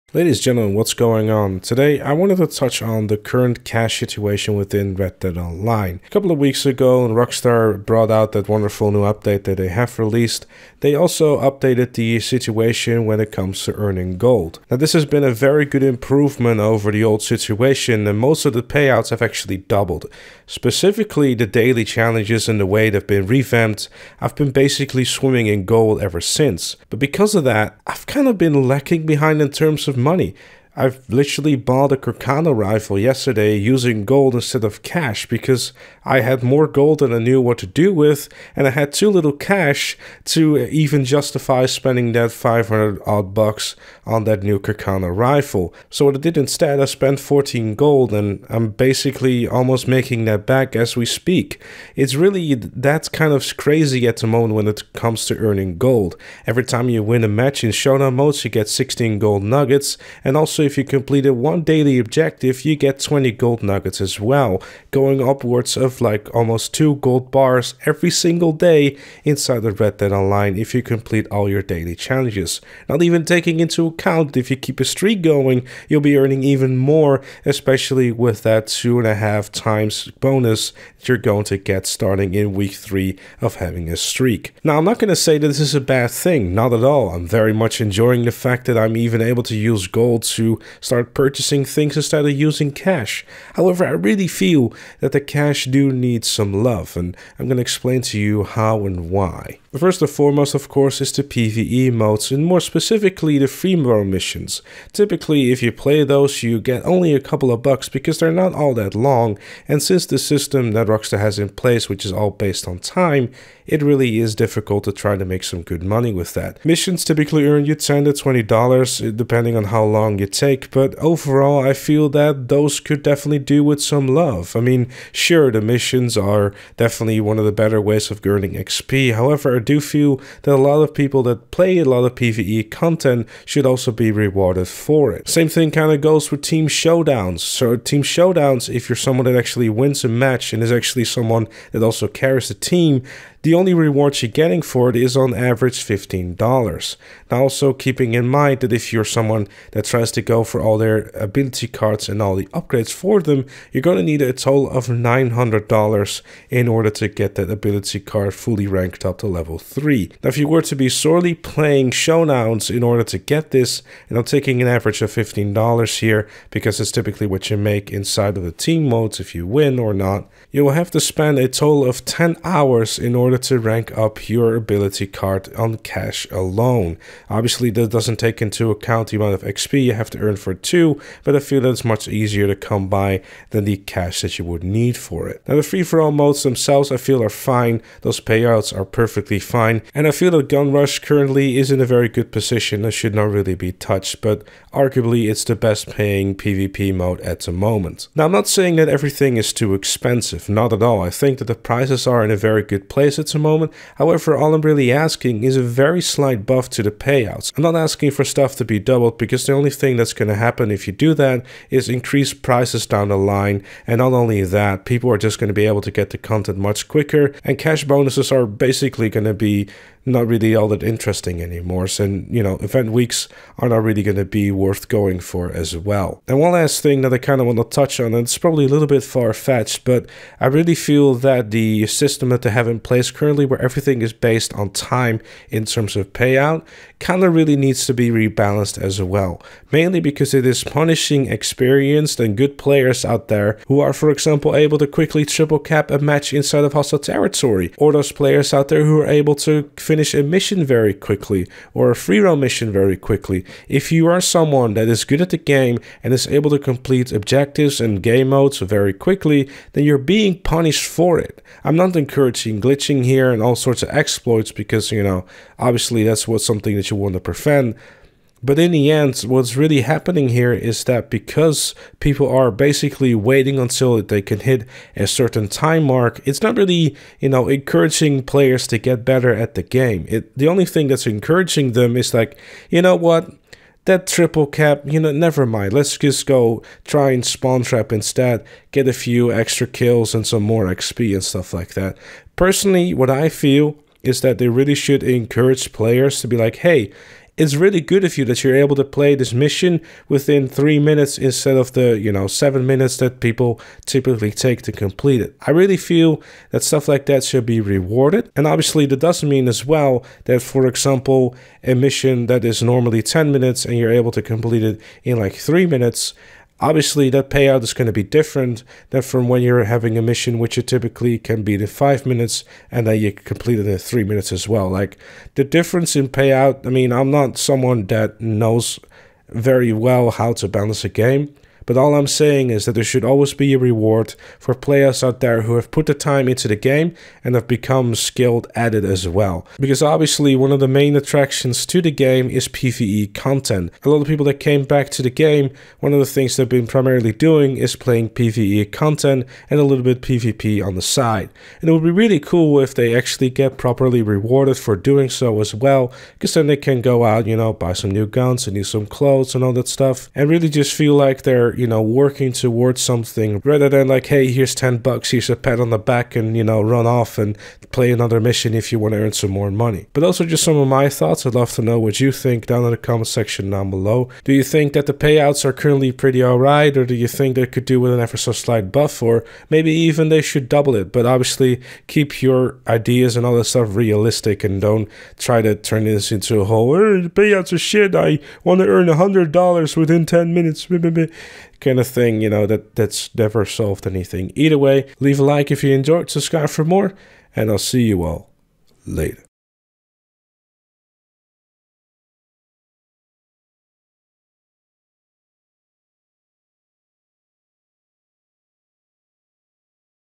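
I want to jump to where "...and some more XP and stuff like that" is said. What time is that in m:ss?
4:50.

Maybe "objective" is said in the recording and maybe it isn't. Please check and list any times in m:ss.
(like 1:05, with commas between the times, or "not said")
1:01, 4:17.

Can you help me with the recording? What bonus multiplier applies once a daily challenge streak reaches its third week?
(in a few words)
2.5 times.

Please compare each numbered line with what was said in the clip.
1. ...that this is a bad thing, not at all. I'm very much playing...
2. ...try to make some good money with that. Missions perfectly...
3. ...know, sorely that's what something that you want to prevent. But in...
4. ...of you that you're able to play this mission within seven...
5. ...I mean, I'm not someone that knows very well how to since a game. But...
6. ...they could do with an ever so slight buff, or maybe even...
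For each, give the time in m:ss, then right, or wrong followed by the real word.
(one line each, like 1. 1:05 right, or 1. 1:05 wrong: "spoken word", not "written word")
1. 1:25 wrong: "enjoying", not "playing"
2. 1:54 wrong: "typically", not "perfectly"
3. 4:25 wrong: "obviously", not "sorely"
4. 4:58 wrong: "three", not "seven"
5. 5:26 wrong: "balance", not "since"
6. 6:17 right.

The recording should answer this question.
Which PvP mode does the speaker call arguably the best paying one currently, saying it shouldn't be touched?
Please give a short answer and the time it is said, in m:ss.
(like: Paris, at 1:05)
Gun Rush, at 3:10.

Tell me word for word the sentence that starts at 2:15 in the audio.
Same thing kind of goes with team showdowns.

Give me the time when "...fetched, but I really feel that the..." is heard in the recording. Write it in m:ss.
3:49.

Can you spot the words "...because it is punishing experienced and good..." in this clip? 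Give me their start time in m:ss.
3:59.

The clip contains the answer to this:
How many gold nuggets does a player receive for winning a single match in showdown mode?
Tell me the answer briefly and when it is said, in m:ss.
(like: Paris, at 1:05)
16, at 0:58.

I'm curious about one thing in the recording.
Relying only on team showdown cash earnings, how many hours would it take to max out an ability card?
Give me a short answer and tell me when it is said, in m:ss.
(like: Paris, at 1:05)
10 hours, at 2:52.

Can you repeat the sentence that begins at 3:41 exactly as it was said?
So, you know, event weeks are not really going to be worth going for as well.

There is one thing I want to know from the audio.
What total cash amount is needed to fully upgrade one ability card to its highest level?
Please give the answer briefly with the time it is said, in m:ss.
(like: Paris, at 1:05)
$900, at 2:34.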